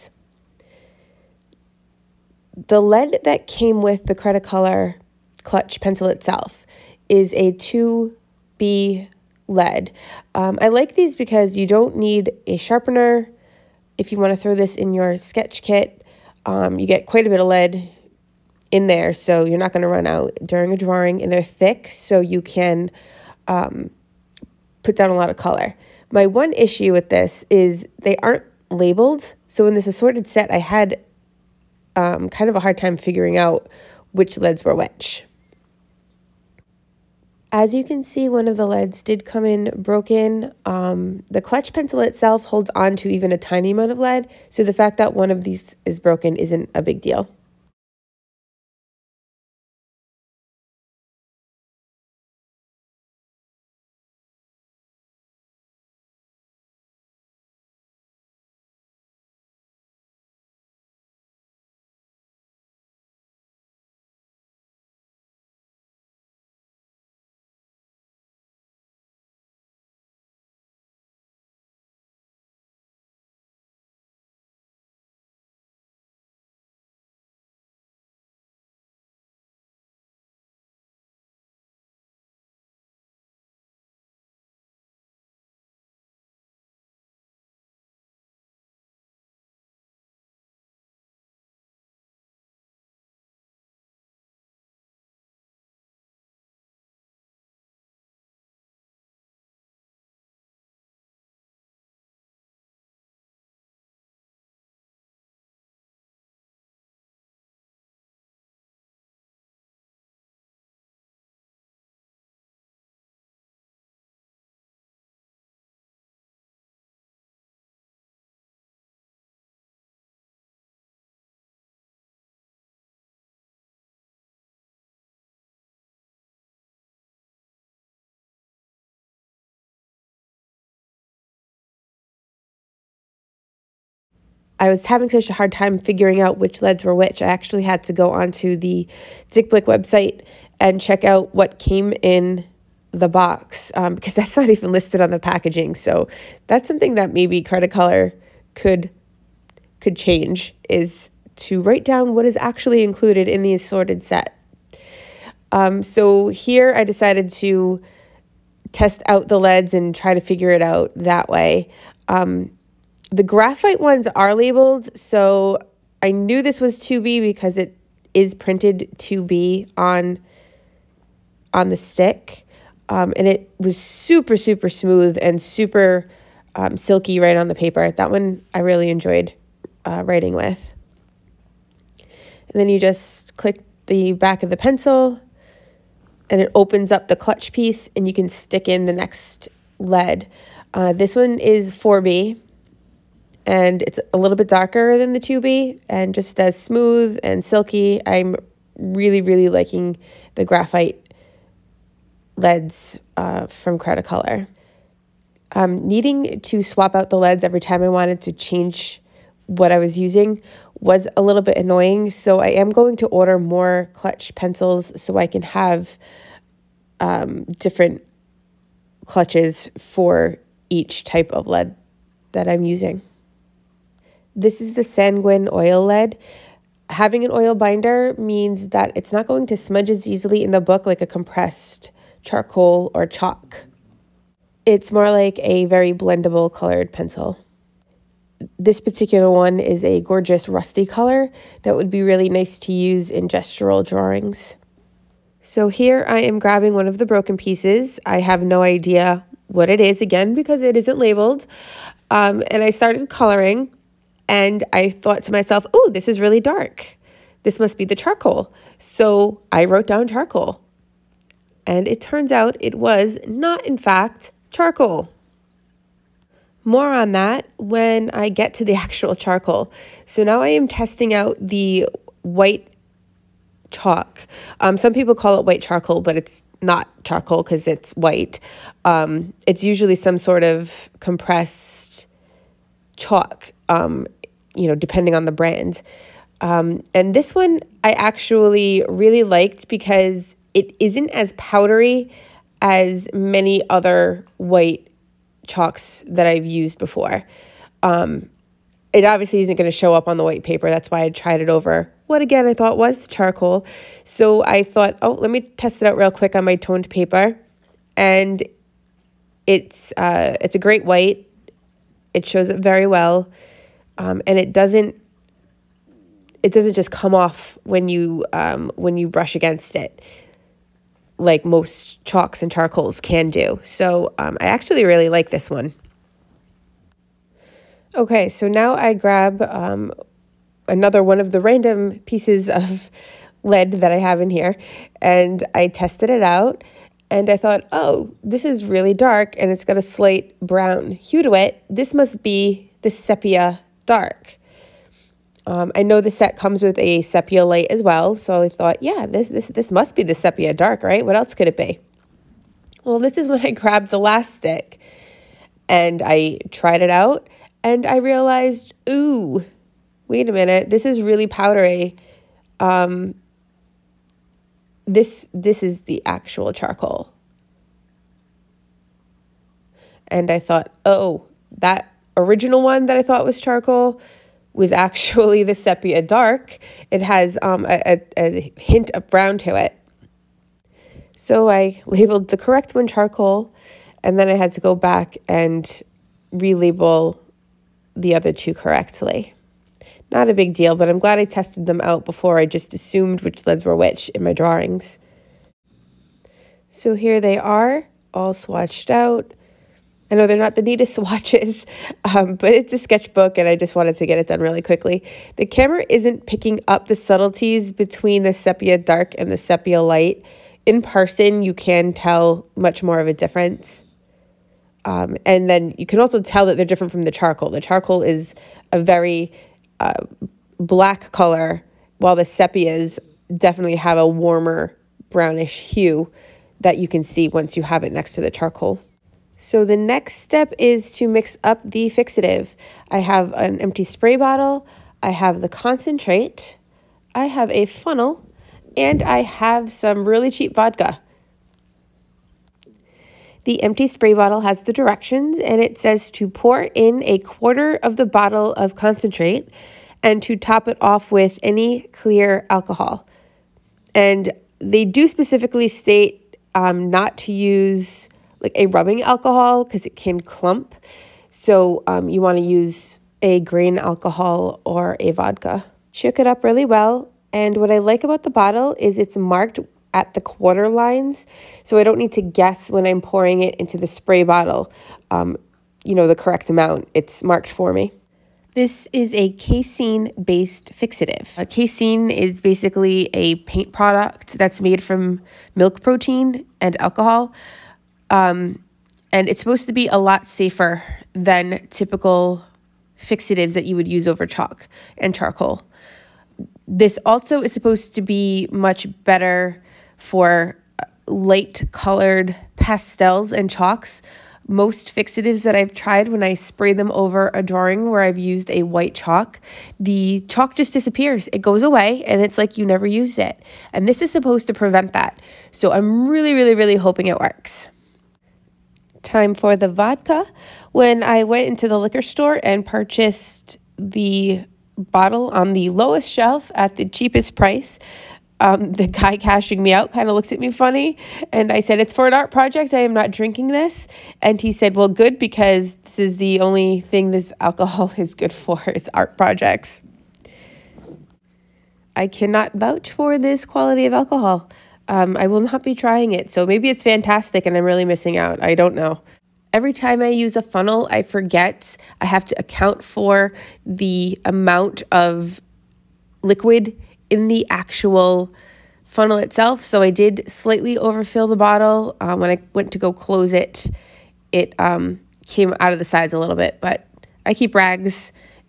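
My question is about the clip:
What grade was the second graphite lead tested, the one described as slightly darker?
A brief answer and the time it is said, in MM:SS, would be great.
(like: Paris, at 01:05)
4B, at 03:11.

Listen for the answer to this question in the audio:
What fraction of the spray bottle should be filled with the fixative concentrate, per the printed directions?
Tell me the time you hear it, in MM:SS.
07:27.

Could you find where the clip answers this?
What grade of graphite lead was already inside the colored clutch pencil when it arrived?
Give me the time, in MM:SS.
00:07.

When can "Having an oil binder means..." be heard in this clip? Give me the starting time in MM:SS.
03:46.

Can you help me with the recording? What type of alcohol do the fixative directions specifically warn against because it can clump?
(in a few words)
rubbing alcohol.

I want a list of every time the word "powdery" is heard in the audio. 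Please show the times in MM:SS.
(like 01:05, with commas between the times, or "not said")
04:51, 06:01.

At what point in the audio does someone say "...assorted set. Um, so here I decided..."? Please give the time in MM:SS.
02:33.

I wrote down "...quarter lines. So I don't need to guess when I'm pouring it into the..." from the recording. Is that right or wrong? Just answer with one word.
right.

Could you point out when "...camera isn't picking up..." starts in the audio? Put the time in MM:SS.
06:45.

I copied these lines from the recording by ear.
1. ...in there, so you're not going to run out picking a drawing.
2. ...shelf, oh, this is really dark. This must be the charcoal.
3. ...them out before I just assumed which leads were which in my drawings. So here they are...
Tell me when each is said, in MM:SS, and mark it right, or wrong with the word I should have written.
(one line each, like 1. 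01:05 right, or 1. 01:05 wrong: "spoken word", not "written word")
1. 00:18 wrong: "during", not "picking"
2. 04:15 wrong: "myself", not "shelf"
3. 06:31 right.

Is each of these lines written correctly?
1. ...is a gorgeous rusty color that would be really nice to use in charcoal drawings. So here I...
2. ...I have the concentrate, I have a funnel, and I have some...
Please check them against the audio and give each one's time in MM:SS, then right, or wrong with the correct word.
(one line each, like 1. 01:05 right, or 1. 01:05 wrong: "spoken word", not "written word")
1. 03:59 wrong: "gestural", not "charcoal"
2. 07:15 right.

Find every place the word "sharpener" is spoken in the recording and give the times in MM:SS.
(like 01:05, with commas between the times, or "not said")
00:12.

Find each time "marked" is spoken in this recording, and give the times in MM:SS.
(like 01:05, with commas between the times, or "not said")
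07:49, 07:57.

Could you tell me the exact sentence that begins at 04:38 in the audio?
Um, it's usually some sort of compressed chalk, um, you know, depending on the brand.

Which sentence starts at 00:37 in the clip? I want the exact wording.
As you can see, one of the leads did come in broken.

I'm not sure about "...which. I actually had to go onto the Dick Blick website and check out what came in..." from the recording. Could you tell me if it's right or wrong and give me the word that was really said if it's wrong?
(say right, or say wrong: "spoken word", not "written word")
right.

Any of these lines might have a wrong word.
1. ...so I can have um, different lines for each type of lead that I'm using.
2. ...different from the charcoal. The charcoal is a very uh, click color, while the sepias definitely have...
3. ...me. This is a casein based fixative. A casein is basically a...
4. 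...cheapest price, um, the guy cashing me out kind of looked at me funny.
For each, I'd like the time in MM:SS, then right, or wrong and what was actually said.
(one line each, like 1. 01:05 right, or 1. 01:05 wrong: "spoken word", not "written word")
1. 03:35 wrong: "clutches", not "lines"
2. 06:56 wrong: "black", not "click"
3. 07:57 right
4. 08:46 right.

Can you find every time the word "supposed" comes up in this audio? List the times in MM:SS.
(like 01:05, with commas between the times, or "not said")
08:09, 08:17, 08:34.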